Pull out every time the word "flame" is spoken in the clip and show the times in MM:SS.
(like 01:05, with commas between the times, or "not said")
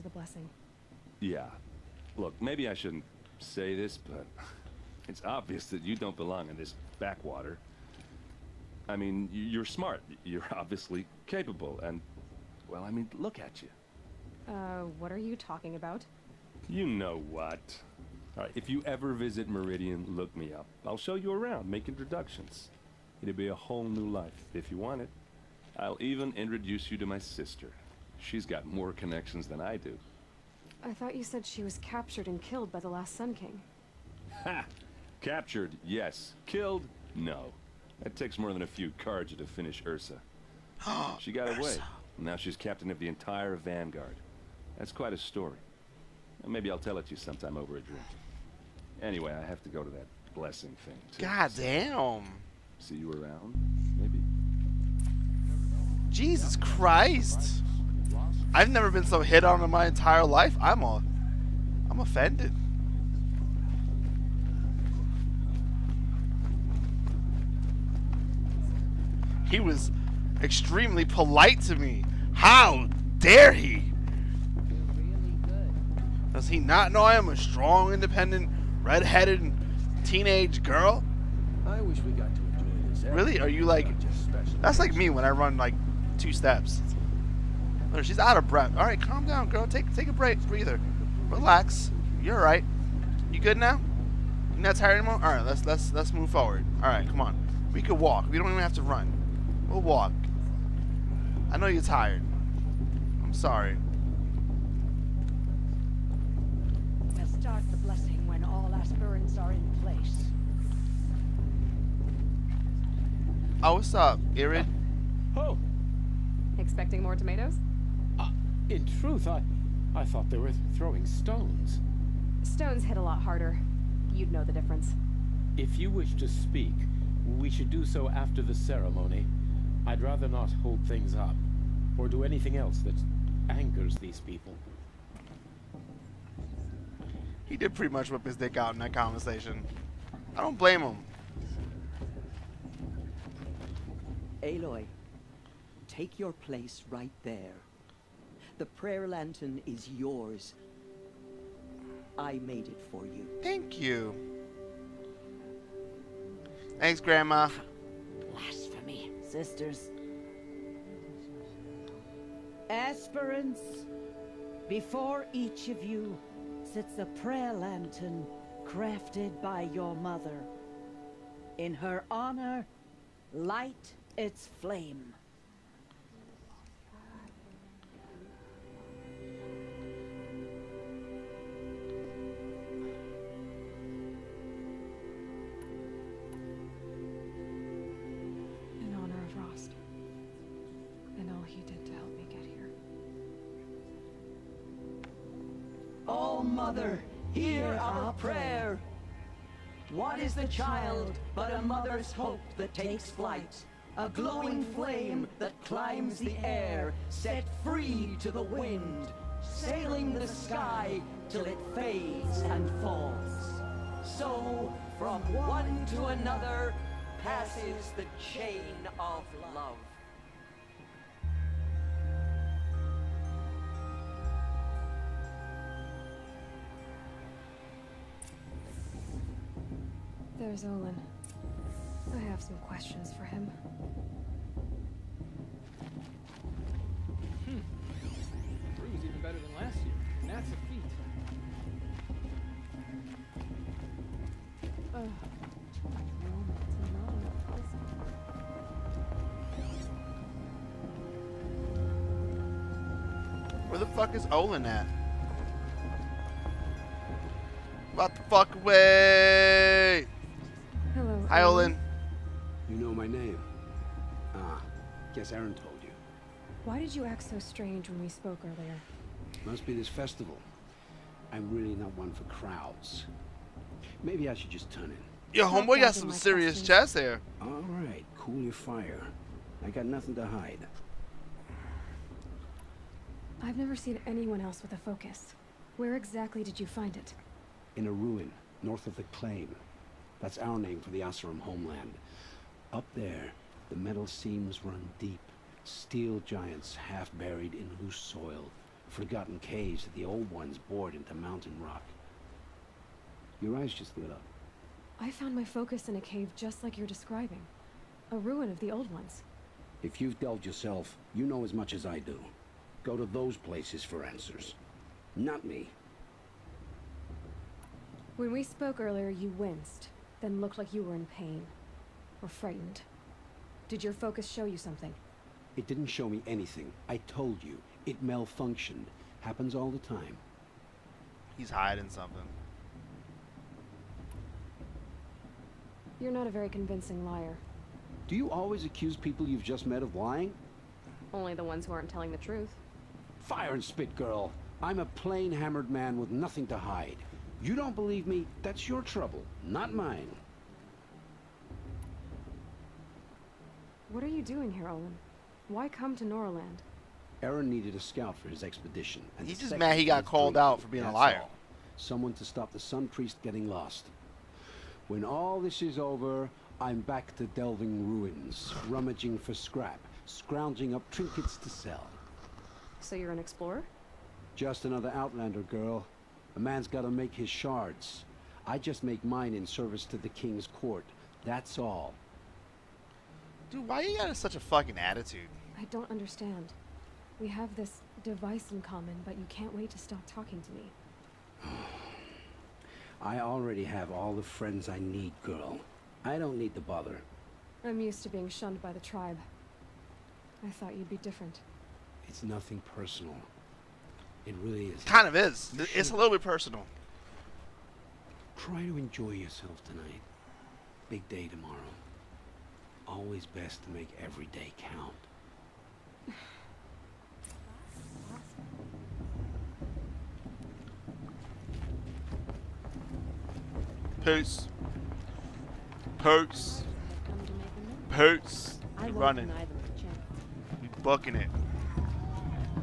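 02:54, 03:24.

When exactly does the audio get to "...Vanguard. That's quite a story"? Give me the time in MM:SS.
00:43.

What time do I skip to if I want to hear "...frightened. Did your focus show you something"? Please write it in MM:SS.
05:22.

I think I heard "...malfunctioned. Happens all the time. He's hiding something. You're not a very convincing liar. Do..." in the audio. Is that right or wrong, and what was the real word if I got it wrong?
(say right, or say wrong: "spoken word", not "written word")
right.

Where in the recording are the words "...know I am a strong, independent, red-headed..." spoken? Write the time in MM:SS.
01:16.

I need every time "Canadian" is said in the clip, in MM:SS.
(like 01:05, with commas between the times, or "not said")
not said.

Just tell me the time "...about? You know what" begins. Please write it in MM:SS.
00:15.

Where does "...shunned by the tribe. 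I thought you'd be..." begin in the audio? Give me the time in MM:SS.
06:38.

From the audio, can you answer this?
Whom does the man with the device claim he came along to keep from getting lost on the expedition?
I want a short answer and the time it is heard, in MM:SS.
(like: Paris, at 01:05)
The Sun Priest, at 06:02.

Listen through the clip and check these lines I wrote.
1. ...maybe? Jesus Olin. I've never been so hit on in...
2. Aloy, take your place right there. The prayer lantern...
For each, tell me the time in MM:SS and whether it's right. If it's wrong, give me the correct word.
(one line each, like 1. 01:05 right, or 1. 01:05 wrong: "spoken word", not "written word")
1. 00:53 wrong: "Christ", not "Olin"
2. 02:24 right.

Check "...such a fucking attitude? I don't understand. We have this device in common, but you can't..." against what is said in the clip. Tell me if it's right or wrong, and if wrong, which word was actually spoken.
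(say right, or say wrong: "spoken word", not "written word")
right.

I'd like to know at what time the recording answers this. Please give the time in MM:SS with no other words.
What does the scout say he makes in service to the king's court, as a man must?
06:17.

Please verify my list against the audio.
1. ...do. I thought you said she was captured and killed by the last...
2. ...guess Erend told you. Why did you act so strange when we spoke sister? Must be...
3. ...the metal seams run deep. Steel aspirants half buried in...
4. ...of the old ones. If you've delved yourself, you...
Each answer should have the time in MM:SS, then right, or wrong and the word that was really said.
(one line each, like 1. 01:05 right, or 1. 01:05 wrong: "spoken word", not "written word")
1. 00:29 right
2. 04:25 wrong: "earlier", not "sister"
3. 04:53 wrong: "giants", not "aspirants"
4. 05:08 right.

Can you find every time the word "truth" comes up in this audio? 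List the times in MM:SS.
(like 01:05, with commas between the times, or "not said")
01:58, 05:42.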